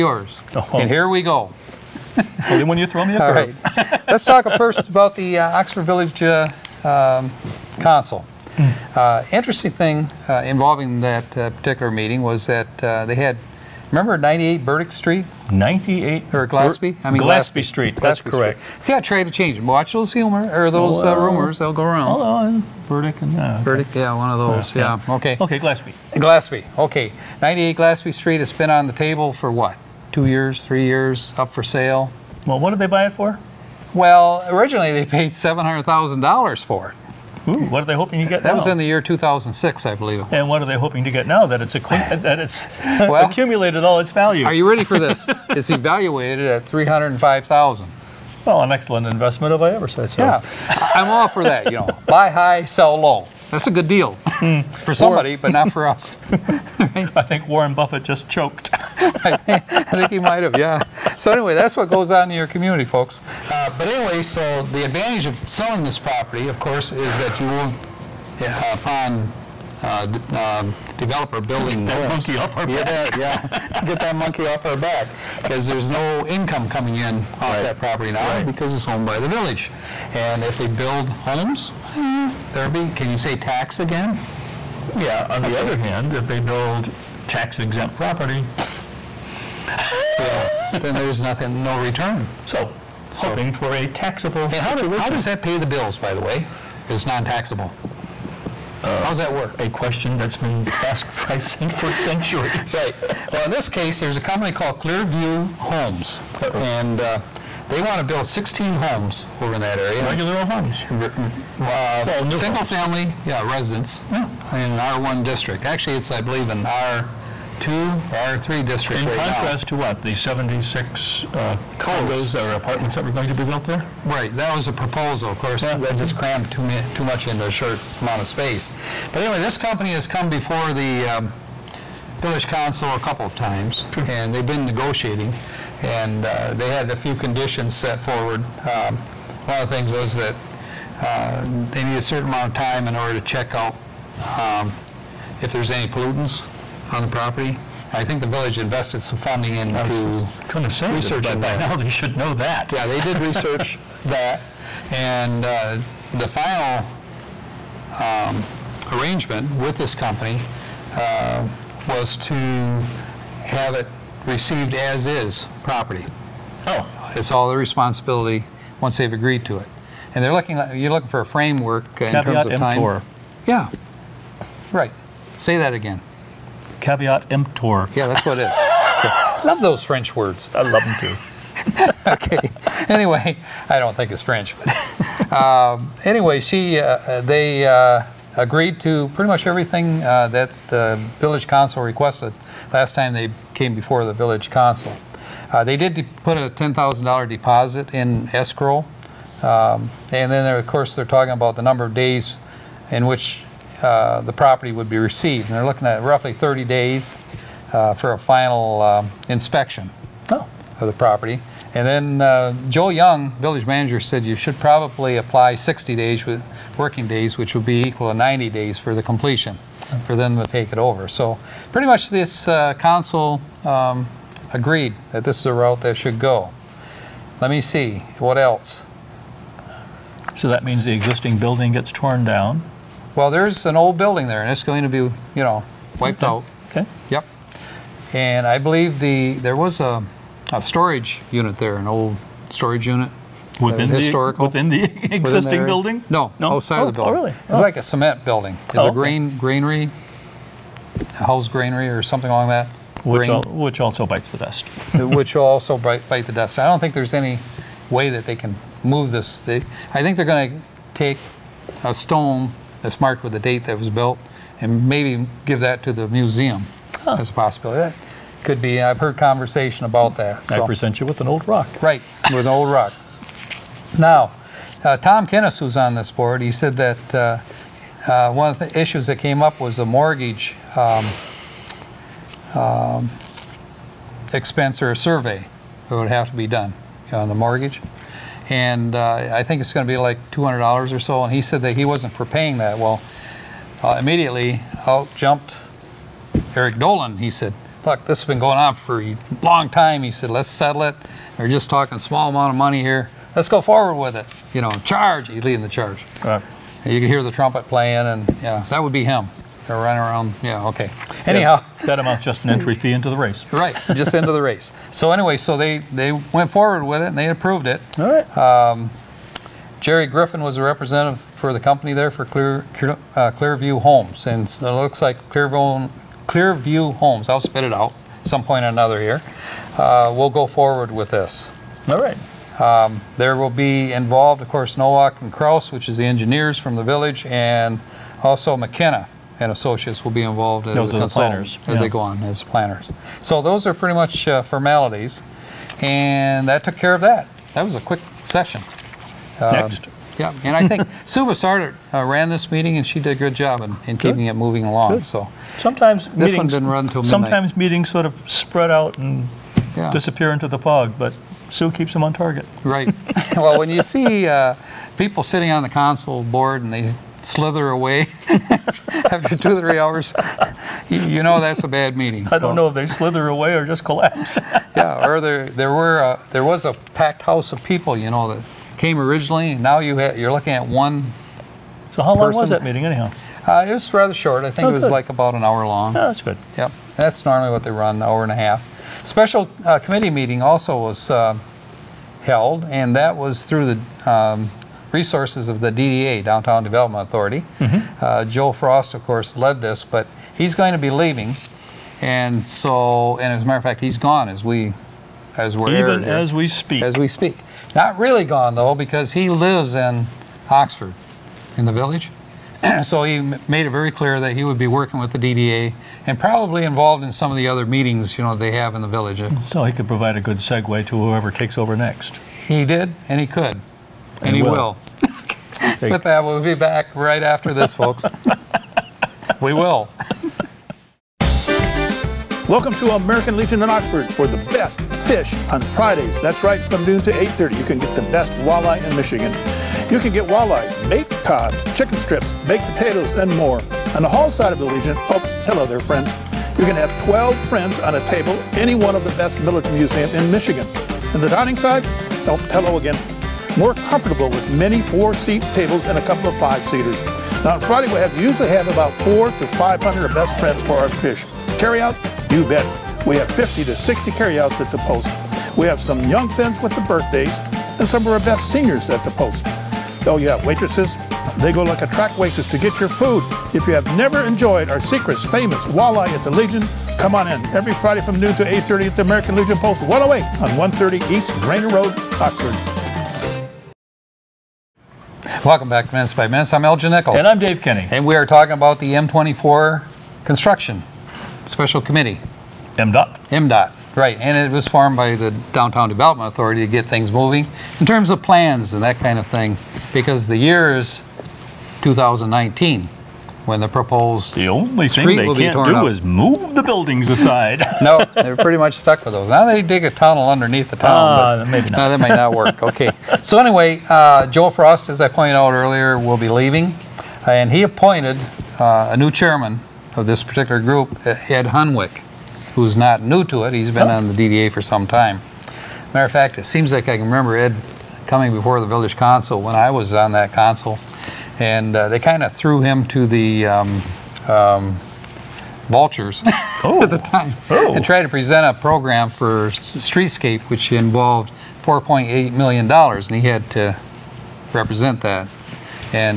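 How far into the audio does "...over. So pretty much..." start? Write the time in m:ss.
3:40.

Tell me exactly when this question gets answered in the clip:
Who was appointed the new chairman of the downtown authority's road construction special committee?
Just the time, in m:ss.
8:41.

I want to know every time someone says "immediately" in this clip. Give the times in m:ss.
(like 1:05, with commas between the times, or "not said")
4:53.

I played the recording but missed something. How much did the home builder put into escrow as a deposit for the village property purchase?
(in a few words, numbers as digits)
$10,000.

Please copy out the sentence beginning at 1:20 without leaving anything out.
And if they build homes, eh, therapy.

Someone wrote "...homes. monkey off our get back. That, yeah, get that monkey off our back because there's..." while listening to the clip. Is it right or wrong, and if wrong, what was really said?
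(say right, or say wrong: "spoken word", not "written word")
right.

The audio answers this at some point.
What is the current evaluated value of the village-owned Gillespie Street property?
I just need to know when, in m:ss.
0:46.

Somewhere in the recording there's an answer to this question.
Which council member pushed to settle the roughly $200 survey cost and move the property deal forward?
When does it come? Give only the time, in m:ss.
4:56.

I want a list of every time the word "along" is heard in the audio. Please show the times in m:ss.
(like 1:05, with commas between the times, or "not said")
4:12, 5:54.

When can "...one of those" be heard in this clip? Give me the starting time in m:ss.
0:24.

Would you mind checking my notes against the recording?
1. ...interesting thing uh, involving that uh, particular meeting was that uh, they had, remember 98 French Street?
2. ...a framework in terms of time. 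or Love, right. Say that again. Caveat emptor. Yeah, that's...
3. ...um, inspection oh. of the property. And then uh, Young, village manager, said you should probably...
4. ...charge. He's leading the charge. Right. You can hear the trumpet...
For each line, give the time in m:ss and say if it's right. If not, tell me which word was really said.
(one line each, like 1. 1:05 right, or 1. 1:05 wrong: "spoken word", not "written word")
1. 0:09 wrong: "Burdick", not "French"
2. 2:51 wrong: "Yeah", not "Love"
3. 3:28 right
4. 5:04 right.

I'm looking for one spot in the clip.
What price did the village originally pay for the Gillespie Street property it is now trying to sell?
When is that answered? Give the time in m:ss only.
0:35.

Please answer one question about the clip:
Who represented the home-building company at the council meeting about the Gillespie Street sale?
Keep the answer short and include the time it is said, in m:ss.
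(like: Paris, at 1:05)
Jerry Griffin, at 5:19.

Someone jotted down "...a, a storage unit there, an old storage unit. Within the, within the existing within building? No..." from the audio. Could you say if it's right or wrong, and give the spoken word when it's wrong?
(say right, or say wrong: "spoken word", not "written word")
right.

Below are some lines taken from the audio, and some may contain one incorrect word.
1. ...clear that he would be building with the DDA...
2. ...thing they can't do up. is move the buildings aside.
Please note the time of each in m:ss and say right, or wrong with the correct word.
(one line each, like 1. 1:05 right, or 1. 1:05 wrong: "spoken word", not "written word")
1. 6:53 wrong: "working", not "building"
2. 8:24 right.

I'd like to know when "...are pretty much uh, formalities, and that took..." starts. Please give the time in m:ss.
5:43.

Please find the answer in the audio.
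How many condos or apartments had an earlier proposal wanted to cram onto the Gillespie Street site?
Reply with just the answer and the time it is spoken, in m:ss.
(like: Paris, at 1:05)
76, at 2:00.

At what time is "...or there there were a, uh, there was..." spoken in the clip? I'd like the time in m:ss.
6:15.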